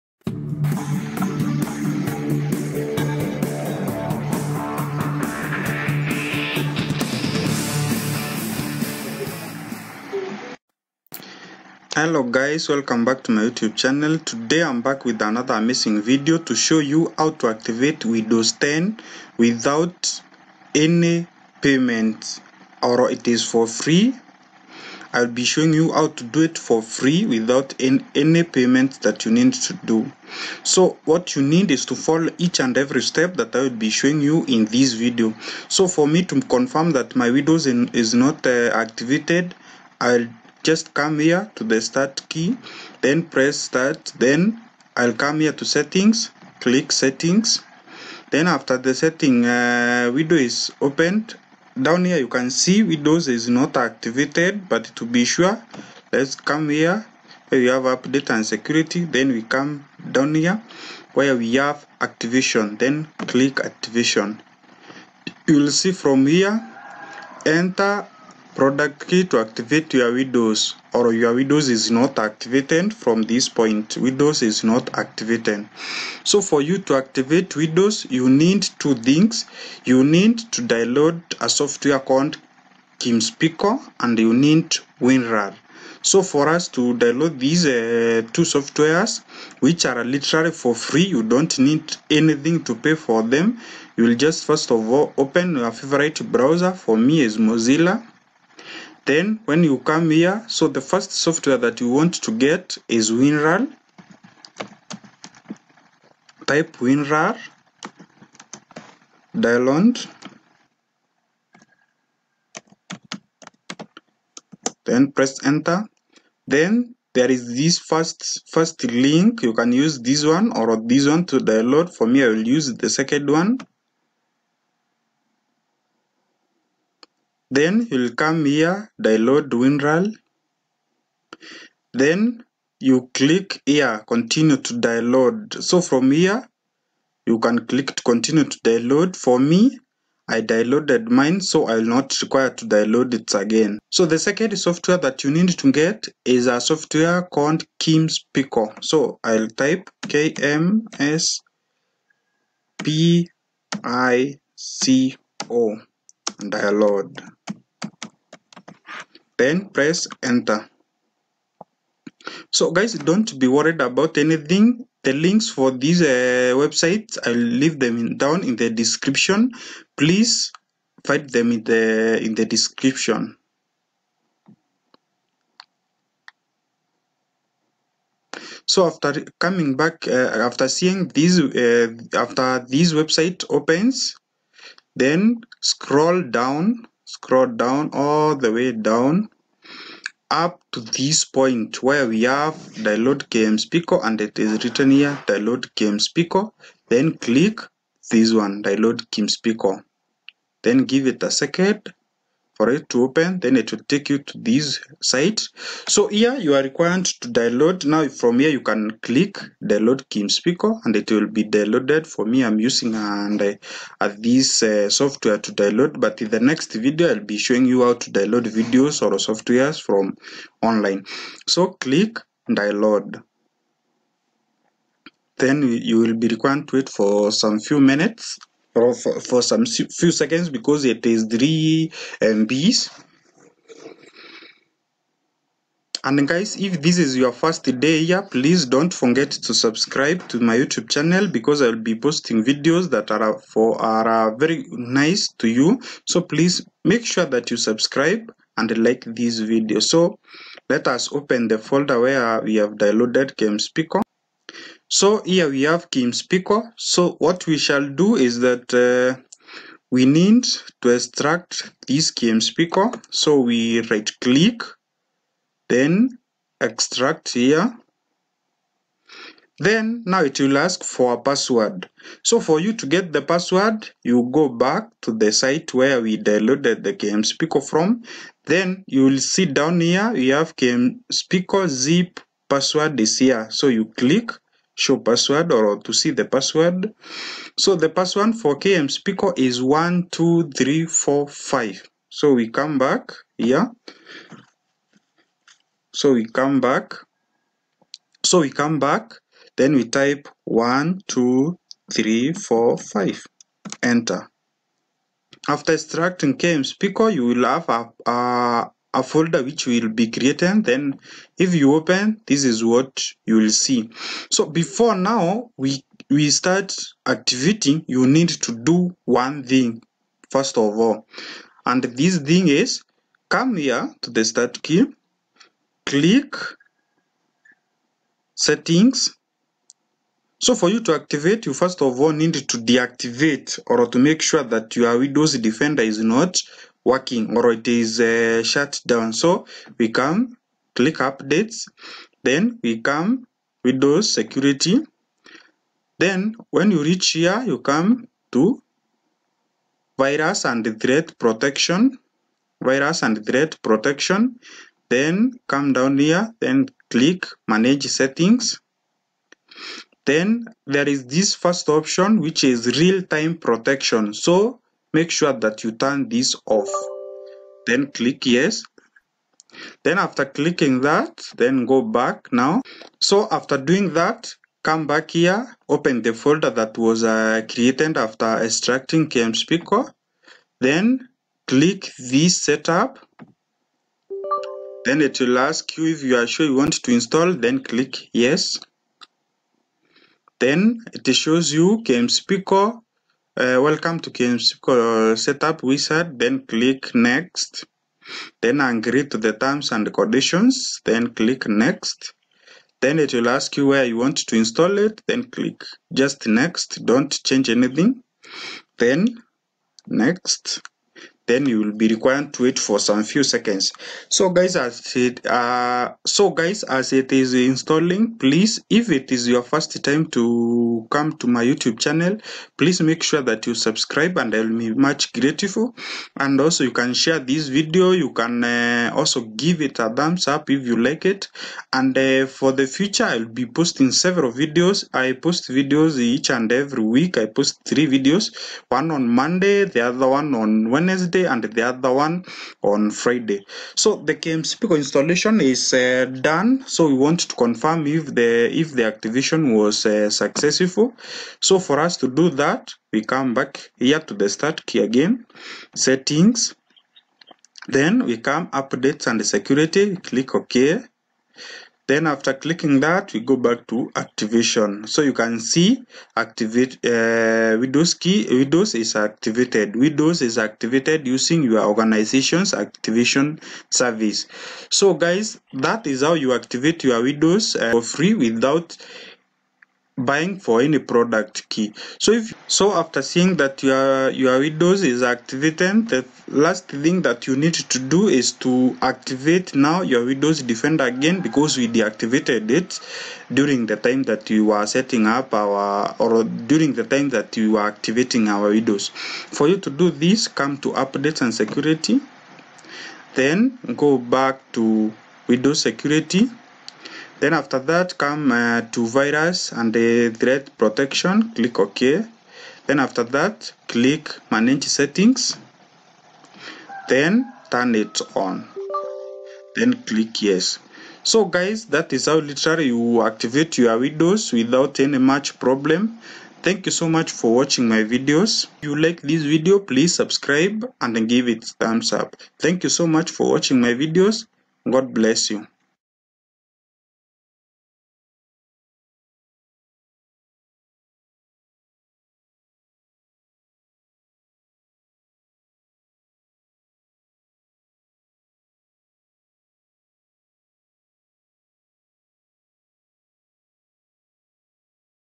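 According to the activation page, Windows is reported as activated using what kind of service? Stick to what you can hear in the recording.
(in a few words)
Your organization's activation service.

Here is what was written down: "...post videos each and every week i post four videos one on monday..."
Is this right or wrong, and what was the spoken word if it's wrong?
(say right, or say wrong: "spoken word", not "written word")
wrong: "three", not "four".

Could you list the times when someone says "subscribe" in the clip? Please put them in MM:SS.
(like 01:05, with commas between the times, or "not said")
03:59, 04:07, 07:03, 08:49.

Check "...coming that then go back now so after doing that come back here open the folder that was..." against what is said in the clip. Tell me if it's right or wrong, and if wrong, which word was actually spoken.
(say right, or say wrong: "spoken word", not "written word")
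wrong: "clicking", not "coming".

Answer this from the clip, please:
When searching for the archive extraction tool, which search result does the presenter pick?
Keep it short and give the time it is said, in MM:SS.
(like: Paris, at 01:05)
The second one, at 02:02.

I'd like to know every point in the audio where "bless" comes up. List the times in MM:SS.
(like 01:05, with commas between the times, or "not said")
08:54.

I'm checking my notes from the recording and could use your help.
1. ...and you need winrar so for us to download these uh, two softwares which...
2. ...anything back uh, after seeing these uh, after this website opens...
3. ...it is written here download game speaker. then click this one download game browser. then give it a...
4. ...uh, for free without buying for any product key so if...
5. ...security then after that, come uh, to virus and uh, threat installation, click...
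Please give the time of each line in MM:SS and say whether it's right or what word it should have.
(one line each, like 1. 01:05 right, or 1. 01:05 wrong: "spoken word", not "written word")
1. 01:24 right
2. 02:59 wrong: "coming", not "anything"
3. 03:14 wrong: "speaker", not "browser"
4. 07:57 right
5. 08:25 wrong: "protection", not "installation".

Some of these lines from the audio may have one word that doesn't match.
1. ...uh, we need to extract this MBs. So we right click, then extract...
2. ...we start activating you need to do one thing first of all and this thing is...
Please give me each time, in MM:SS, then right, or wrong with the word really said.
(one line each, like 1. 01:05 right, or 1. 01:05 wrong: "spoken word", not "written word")
1. 04:18 wrong: "KMSPico", not "MBs"
2. 05:16 right.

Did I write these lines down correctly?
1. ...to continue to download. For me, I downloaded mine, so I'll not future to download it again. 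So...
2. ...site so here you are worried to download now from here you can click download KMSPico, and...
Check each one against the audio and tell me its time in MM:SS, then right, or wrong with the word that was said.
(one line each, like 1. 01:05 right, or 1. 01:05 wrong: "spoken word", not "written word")
1. 02:17 wrong: "require", not "future"
2. 03:25 wrong: "required", not "worried".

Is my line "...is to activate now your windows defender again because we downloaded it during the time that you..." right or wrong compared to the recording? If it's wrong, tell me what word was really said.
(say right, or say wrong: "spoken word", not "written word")
wrong: "deactivated", not "downloaded".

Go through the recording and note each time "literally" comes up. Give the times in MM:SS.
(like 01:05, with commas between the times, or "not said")
01:30, 08:42.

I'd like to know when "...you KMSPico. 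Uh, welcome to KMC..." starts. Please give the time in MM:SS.
06:31.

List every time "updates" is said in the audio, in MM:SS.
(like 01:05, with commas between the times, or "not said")
00:57, 05:40, 07:38, 08:20.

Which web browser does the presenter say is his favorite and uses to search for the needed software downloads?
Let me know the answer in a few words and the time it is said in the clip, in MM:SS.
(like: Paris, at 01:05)
Mozilla, at 01:37.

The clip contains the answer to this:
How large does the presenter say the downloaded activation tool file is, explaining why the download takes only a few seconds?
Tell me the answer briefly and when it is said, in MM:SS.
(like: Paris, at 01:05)
3 MB, at 03:51.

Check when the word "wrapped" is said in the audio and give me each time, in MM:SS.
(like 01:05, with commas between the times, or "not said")
not said.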